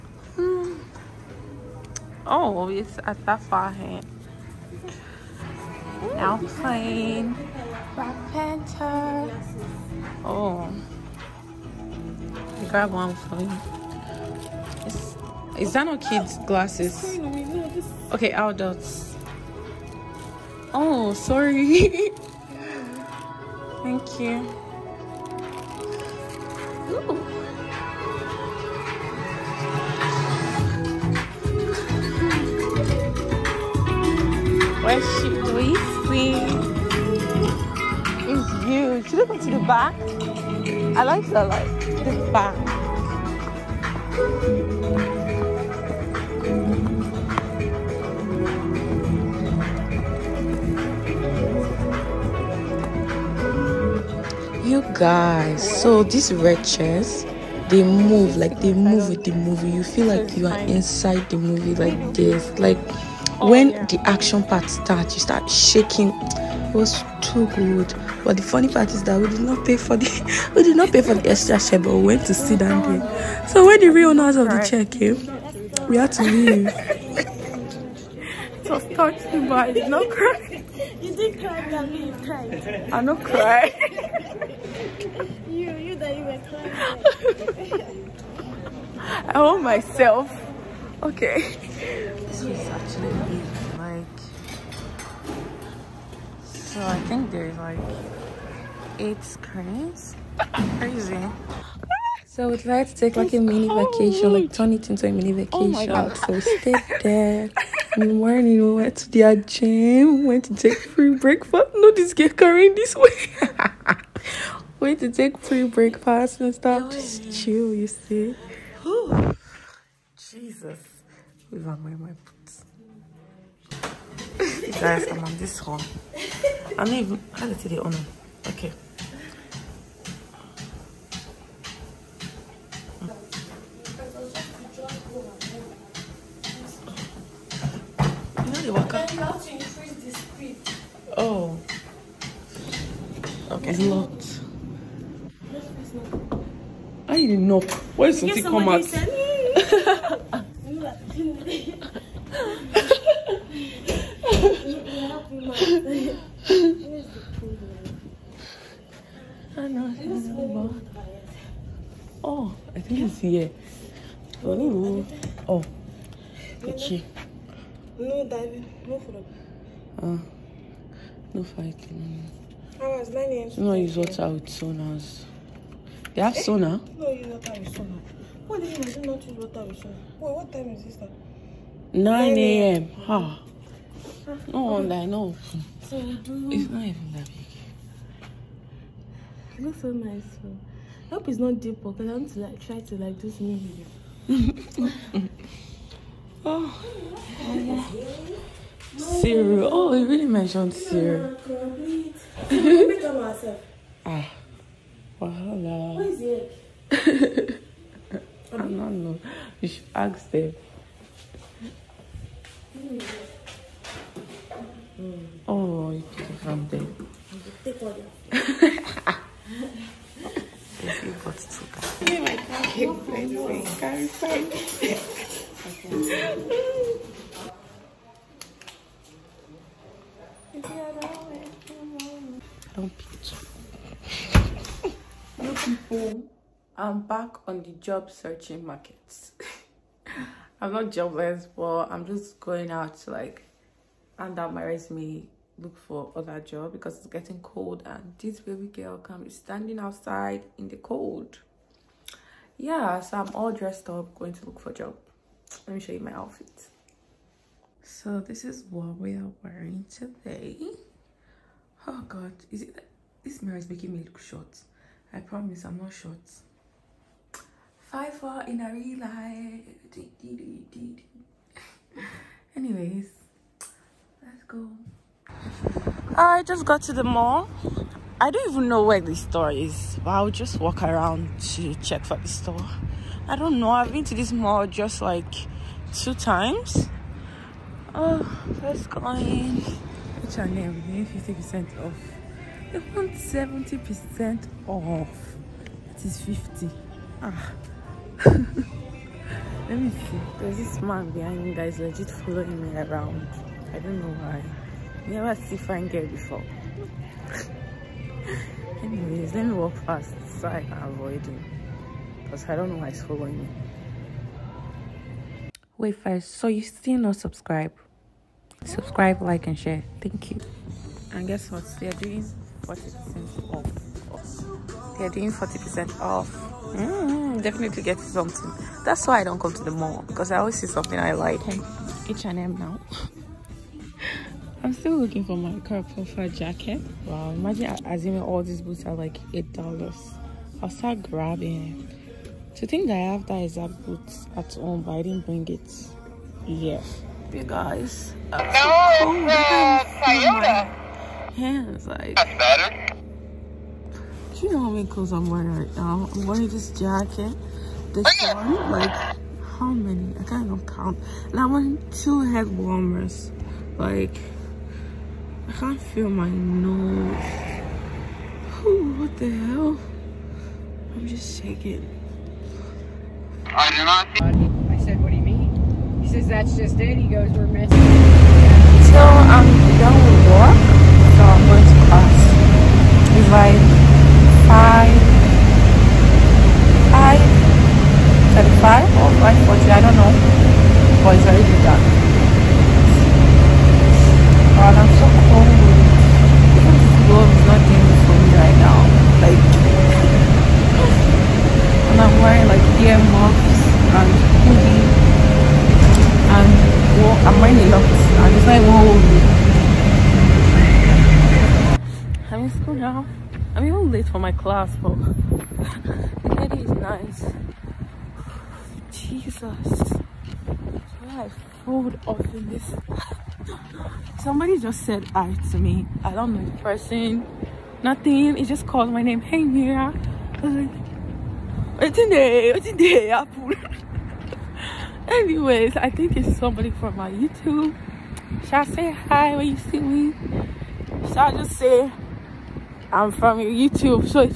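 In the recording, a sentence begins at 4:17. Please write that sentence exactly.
So this is what we are wearing today.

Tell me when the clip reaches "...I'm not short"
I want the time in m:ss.
4:25.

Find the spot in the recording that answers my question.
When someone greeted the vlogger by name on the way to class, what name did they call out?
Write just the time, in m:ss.
7:09.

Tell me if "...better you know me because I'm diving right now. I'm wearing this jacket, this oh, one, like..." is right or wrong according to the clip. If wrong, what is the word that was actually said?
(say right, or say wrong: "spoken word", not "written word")
wrong: "wearing", not "diving".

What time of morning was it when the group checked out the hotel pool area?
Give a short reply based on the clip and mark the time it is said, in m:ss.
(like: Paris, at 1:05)
9 a.m., at 3:01.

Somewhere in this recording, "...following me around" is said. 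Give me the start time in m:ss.
5:02.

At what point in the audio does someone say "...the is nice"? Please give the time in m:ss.
6:56.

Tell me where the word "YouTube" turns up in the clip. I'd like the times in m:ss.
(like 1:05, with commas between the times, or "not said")
7:17, 7:23.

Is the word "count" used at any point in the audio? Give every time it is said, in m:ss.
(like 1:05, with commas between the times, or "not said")
6:00.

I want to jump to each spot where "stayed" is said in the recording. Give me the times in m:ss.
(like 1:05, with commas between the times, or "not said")
1:46.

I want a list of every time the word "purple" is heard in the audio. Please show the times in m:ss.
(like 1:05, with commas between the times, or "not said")
not said.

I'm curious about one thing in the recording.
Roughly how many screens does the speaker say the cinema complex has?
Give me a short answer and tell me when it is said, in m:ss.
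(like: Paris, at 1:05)
8, at 1:38.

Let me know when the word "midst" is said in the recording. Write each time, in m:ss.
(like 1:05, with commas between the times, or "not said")
not said.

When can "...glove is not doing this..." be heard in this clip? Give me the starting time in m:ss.
6:37.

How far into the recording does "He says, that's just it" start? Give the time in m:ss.
6:16.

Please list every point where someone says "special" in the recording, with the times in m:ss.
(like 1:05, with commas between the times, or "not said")
not said.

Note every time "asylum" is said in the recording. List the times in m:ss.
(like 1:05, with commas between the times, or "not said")
not said.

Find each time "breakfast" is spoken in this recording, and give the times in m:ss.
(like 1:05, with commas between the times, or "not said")
1:51, 1:55.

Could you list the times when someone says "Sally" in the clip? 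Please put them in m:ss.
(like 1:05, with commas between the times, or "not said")
not said.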